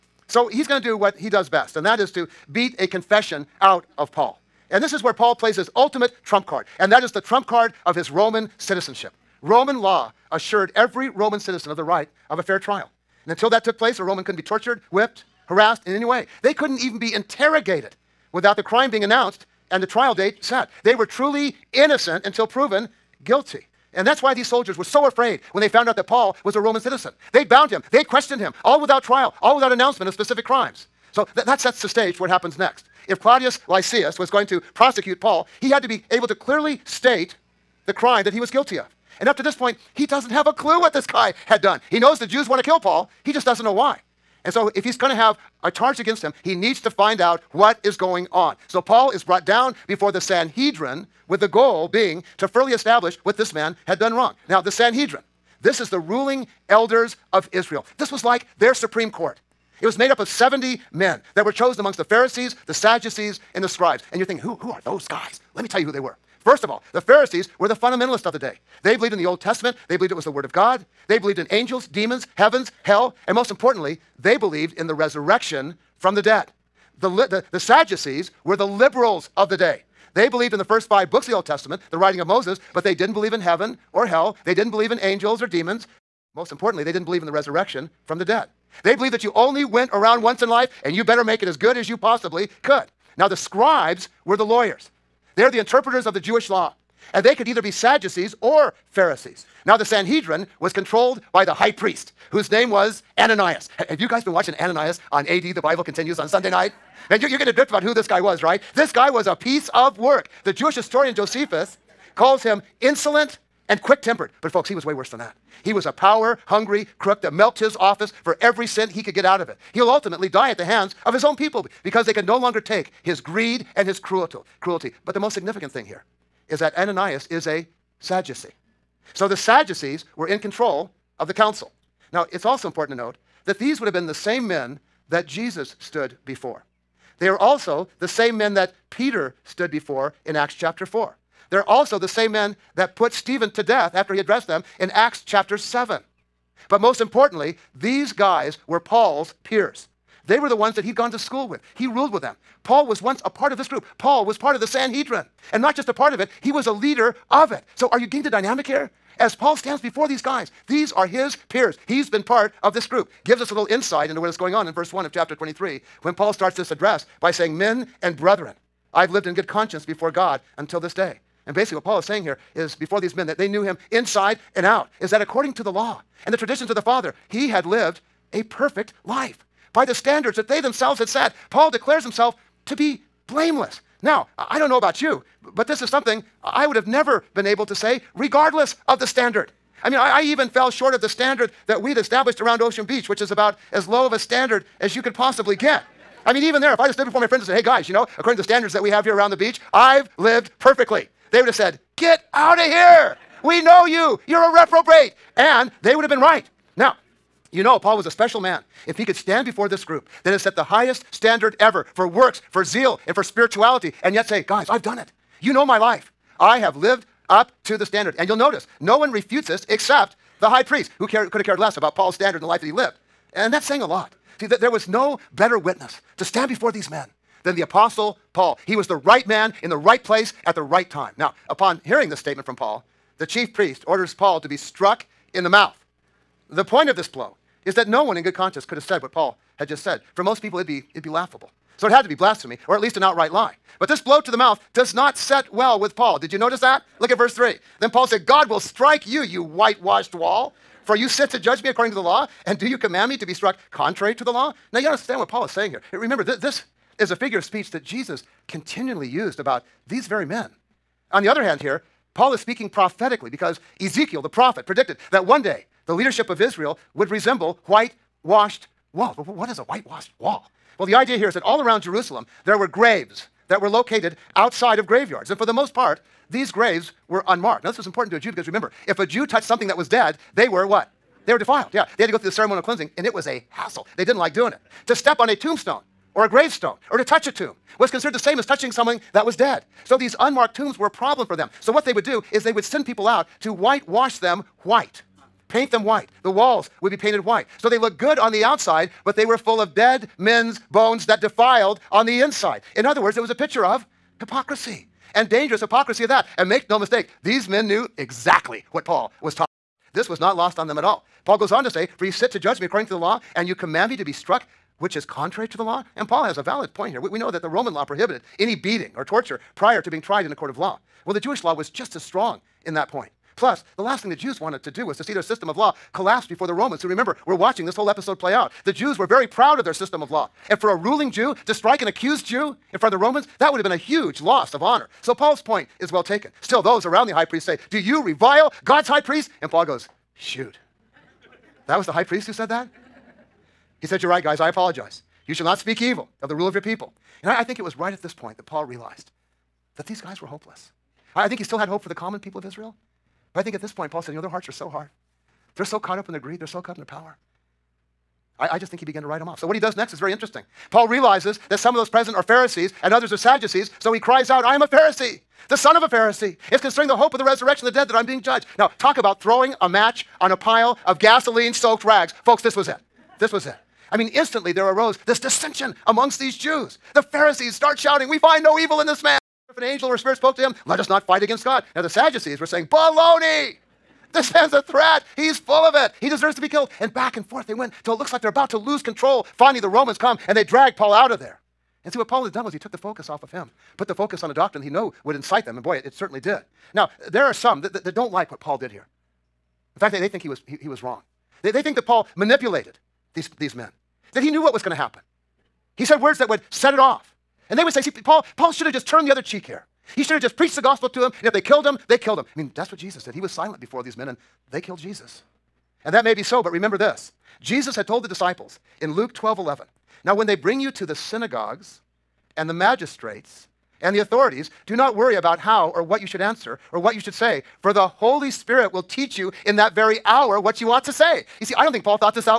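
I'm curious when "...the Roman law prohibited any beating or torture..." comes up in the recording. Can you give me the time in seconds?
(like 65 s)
317 s.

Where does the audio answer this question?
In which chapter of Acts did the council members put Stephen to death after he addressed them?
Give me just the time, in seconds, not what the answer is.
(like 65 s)
144 s.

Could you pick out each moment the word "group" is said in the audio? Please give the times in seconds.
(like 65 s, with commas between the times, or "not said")
153 s, 162 s, 209 s.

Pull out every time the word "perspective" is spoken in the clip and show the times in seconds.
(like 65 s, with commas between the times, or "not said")
not said.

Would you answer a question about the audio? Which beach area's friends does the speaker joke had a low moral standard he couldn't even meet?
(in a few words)
Ocean Beach.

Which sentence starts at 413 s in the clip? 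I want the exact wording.
He was silent before these men, and they killed Jesus.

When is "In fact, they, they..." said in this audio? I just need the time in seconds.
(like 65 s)
399 s.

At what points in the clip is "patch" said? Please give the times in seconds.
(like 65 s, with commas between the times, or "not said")
not said.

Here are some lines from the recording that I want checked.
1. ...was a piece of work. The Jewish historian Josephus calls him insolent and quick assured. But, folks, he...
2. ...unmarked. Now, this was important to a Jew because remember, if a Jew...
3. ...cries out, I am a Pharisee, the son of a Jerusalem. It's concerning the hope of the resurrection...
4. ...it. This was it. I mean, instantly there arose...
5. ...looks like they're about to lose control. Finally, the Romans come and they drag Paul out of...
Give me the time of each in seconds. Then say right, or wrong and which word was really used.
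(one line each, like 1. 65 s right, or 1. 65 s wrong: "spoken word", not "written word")
1. 109 s wrong: "tempered", not "assured"
2. 277 s right
3. 363 s wrong: "Pharisee", not "Jerusalem"
4. 372 s right
5. 387 s right.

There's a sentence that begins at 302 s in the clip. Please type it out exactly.
In other words, it was a picture of hypocrisy and dangerous hypocrisy of that.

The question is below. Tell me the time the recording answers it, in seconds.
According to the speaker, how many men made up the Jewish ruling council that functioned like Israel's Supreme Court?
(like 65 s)
60 s.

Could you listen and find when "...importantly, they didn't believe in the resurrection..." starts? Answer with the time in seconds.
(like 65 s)
86 s.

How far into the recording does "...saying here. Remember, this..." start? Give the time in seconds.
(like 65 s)
255 s.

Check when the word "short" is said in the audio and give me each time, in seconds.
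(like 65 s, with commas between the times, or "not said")
190 s.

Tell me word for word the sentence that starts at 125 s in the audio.
But the most significant thing here is that Ananias is a Sadducee.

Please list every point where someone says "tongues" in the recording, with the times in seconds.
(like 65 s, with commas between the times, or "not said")
not said.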